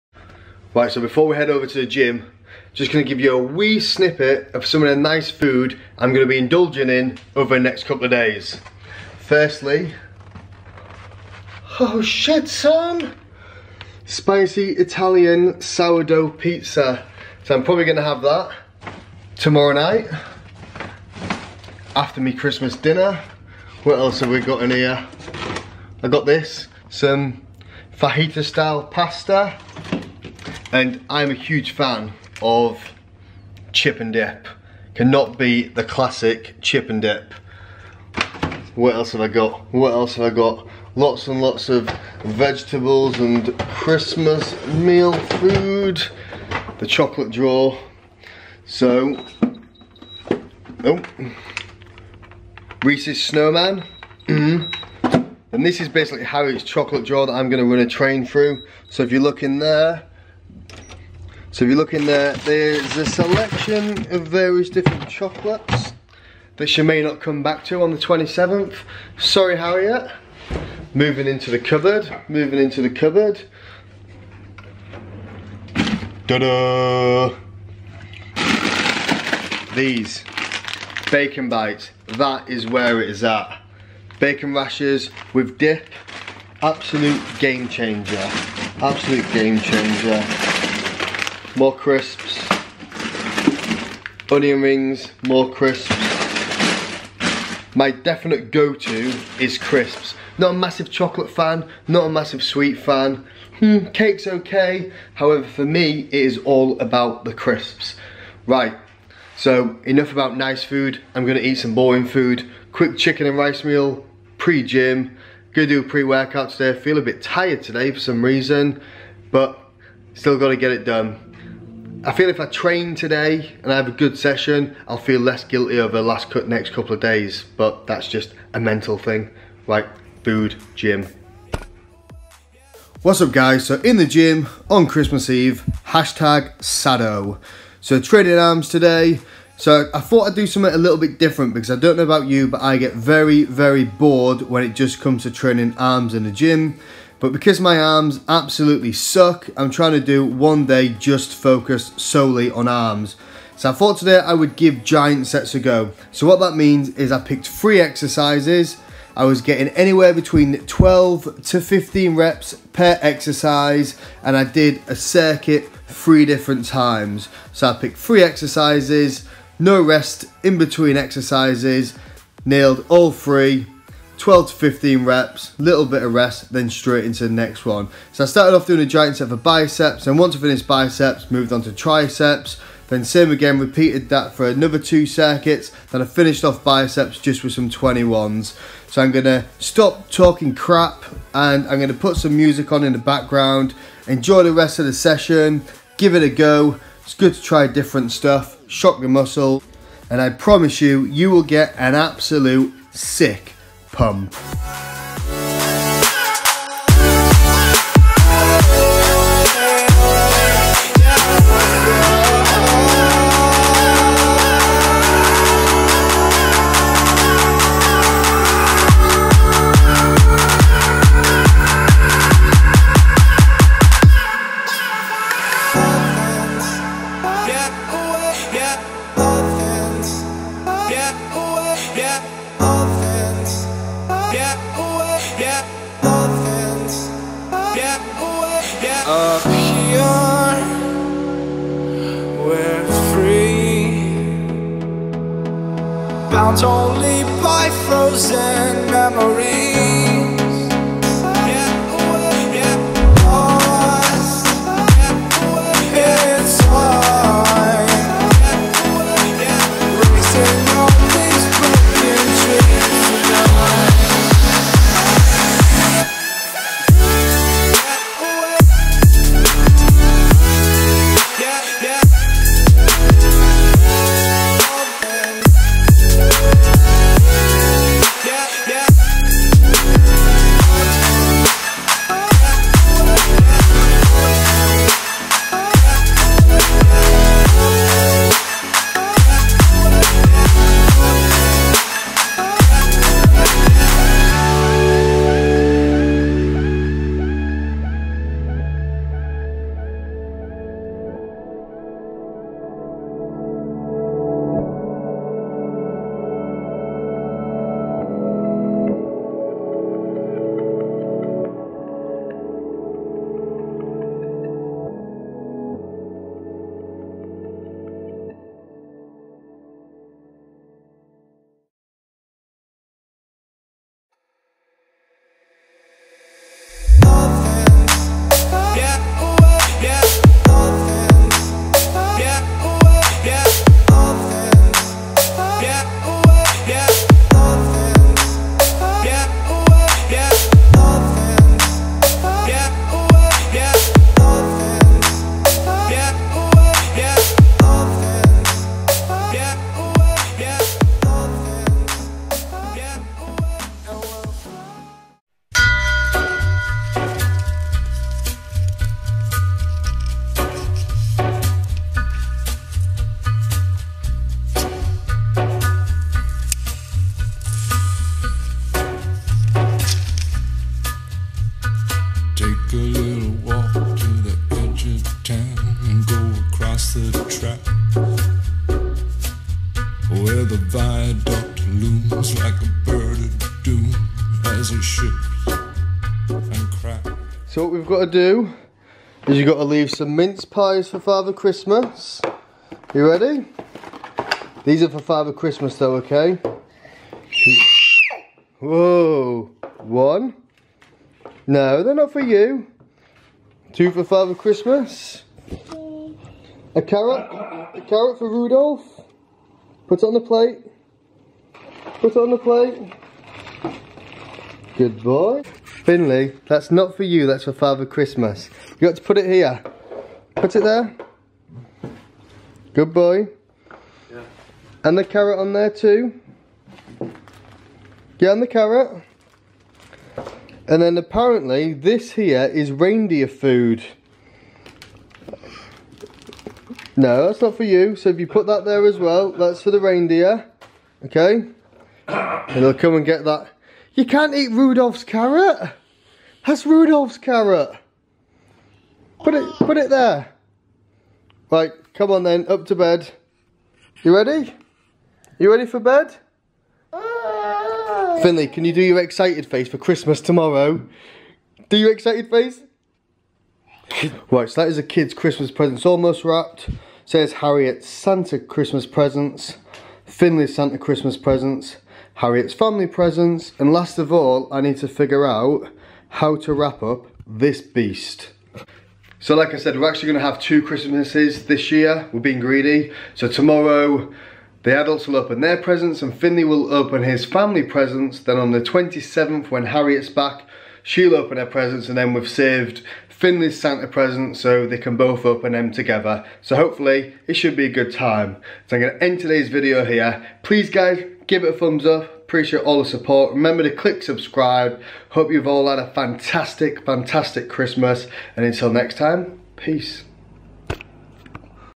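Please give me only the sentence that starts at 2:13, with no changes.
What's up guys, so in the gym on Christmas Eve, hashtag Sado.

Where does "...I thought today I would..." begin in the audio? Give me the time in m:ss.
2:33.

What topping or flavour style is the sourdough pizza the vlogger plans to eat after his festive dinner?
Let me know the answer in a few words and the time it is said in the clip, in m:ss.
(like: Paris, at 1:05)
Spicy Italian, at 0:14.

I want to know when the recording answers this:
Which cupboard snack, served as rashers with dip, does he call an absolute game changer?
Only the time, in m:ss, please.
1:21.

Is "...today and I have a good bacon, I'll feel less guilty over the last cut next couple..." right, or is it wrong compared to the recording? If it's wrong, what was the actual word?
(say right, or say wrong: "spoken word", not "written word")
wrong: "session", not "bacon".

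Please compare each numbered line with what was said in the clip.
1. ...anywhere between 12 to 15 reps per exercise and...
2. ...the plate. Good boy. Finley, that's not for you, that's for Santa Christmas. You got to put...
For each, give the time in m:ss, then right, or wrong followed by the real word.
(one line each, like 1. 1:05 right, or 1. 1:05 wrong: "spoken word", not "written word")
1. 2:39 right
2. 6:52 wrong: "Father", not "Santa".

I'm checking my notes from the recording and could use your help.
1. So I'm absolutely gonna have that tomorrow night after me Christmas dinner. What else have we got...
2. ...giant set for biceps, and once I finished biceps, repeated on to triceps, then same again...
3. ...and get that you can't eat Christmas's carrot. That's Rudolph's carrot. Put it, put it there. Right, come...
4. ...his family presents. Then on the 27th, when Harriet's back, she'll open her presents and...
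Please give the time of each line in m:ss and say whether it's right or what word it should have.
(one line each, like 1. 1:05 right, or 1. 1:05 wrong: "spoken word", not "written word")
1. 0:17 wrong: "probably", not "absolutely"
2. 2:58 wrong: "moved", not "repeated"
3. 7:22 wrong: "Rudolph", not "Christmas"
4. 8:07 right.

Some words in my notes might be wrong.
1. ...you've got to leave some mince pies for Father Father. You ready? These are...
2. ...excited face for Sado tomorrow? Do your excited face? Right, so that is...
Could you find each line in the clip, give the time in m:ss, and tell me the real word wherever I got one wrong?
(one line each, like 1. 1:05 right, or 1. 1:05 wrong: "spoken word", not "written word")
1. 6:29 wrong: "Christmas", not "Father"
2. 7:38 wrong: "Christmas", not "Sado".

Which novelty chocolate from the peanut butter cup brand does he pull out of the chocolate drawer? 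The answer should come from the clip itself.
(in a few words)
Reese's Snowman.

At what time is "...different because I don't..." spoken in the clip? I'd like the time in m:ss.
2:21.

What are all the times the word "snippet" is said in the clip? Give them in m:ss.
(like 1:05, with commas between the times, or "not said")
0:03.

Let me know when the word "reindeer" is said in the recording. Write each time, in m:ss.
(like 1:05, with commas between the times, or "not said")
7:12, 7:19.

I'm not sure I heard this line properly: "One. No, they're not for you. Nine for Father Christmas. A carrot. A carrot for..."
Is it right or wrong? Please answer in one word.
wrong.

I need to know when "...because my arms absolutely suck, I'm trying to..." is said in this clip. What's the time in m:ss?
2:27.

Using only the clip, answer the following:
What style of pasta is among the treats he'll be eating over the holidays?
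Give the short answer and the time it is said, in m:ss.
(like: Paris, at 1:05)
fajita style, at 0:27.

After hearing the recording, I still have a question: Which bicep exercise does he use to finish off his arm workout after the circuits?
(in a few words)
21s.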